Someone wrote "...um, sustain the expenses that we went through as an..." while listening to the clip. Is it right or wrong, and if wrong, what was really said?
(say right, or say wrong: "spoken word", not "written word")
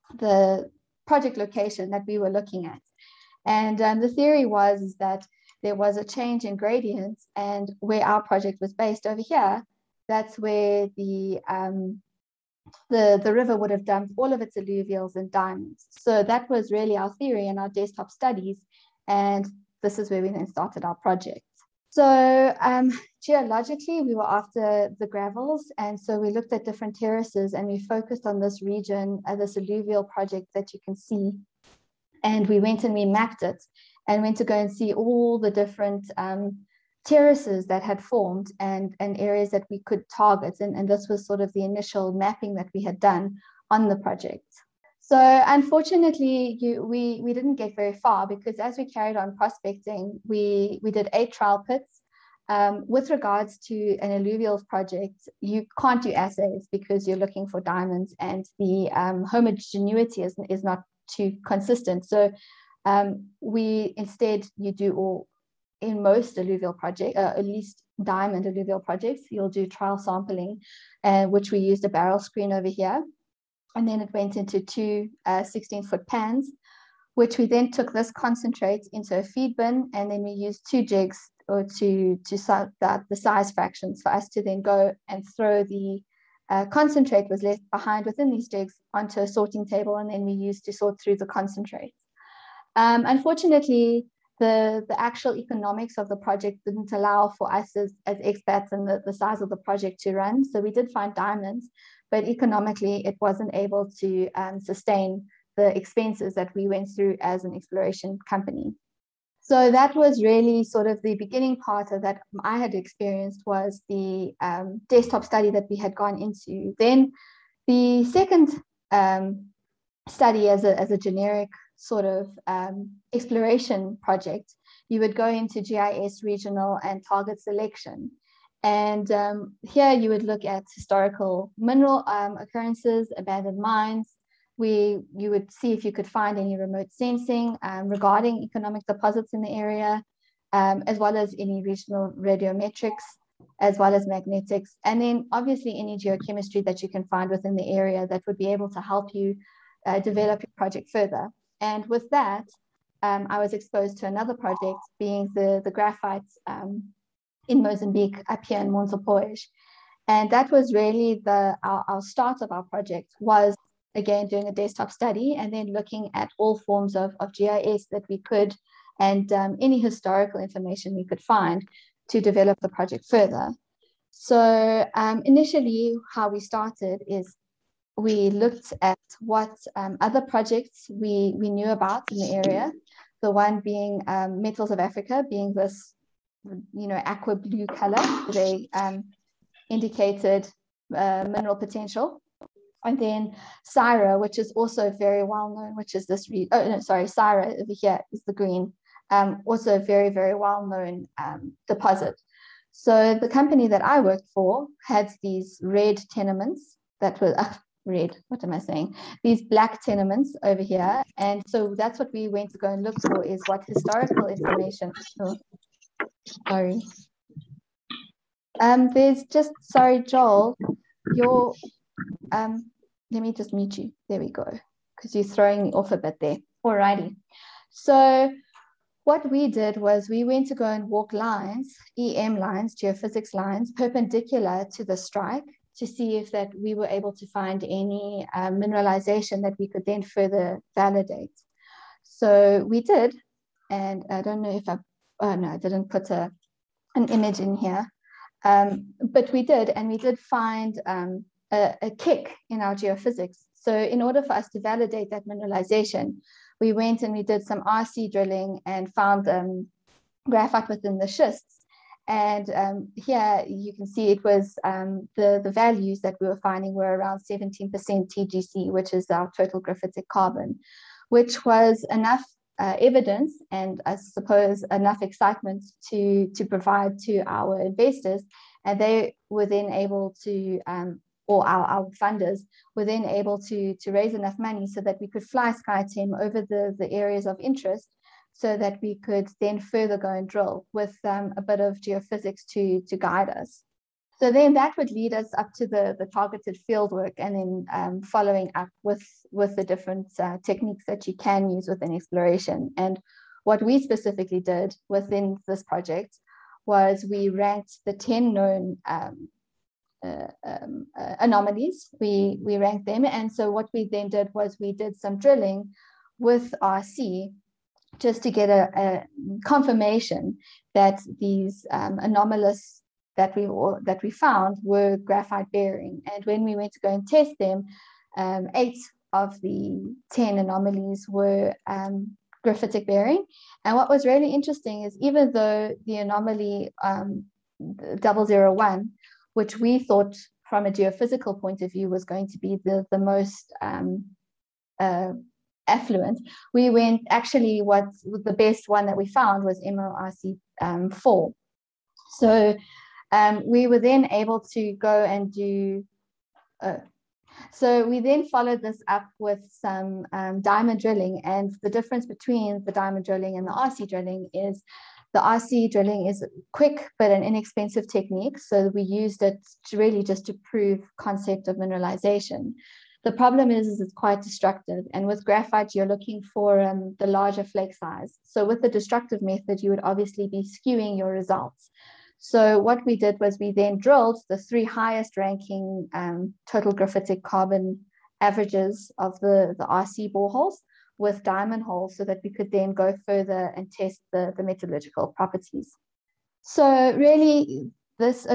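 right.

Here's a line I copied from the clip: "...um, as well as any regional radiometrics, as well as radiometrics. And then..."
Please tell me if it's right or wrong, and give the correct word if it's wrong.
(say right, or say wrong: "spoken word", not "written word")
wrong: "magnetics", not "radiometrics".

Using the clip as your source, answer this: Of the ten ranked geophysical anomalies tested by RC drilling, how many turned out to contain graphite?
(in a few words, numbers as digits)
8.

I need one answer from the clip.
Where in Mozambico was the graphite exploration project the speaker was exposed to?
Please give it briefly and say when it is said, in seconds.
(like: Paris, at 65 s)
Montepuez, at 158 s.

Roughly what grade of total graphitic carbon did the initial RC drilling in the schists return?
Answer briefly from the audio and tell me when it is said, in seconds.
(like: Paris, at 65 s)
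17%, at 267 s.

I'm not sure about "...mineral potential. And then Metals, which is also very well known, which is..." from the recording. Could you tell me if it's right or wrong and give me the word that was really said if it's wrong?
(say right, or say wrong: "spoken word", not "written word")
wrong: "Syrah", not "Metals".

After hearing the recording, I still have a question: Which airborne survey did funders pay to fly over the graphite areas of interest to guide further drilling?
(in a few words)
SkyTEM.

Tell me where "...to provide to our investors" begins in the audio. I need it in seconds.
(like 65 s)
276 s.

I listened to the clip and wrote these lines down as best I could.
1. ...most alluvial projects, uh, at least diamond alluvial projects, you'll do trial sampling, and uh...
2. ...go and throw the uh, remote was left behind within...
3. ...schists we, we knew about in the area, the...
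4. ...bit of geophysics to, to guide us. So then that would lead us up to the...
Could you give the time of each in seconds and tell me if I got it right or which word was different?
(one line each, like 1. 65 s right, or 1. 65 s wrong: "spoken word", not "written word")
1. 66 s right
2. 84 s wrong: "concentrate", not "remote"
3. 180 s wrong: "projects", not "schists"
4. 291 s right.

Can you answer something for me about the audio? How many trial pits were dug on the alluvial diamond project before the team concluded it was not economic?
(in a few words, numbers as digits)
8.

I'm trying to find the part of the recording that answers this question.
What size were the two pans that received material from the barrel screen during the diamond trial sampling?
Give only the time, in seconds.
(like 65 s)
75 s.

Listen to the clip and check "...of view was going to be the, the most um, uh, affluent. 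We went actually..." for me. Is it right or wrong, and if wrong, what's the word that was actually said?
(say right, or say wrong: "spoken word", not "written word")
right.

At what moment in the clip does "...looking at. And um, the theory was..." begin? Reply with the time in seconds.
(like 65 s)
2 s.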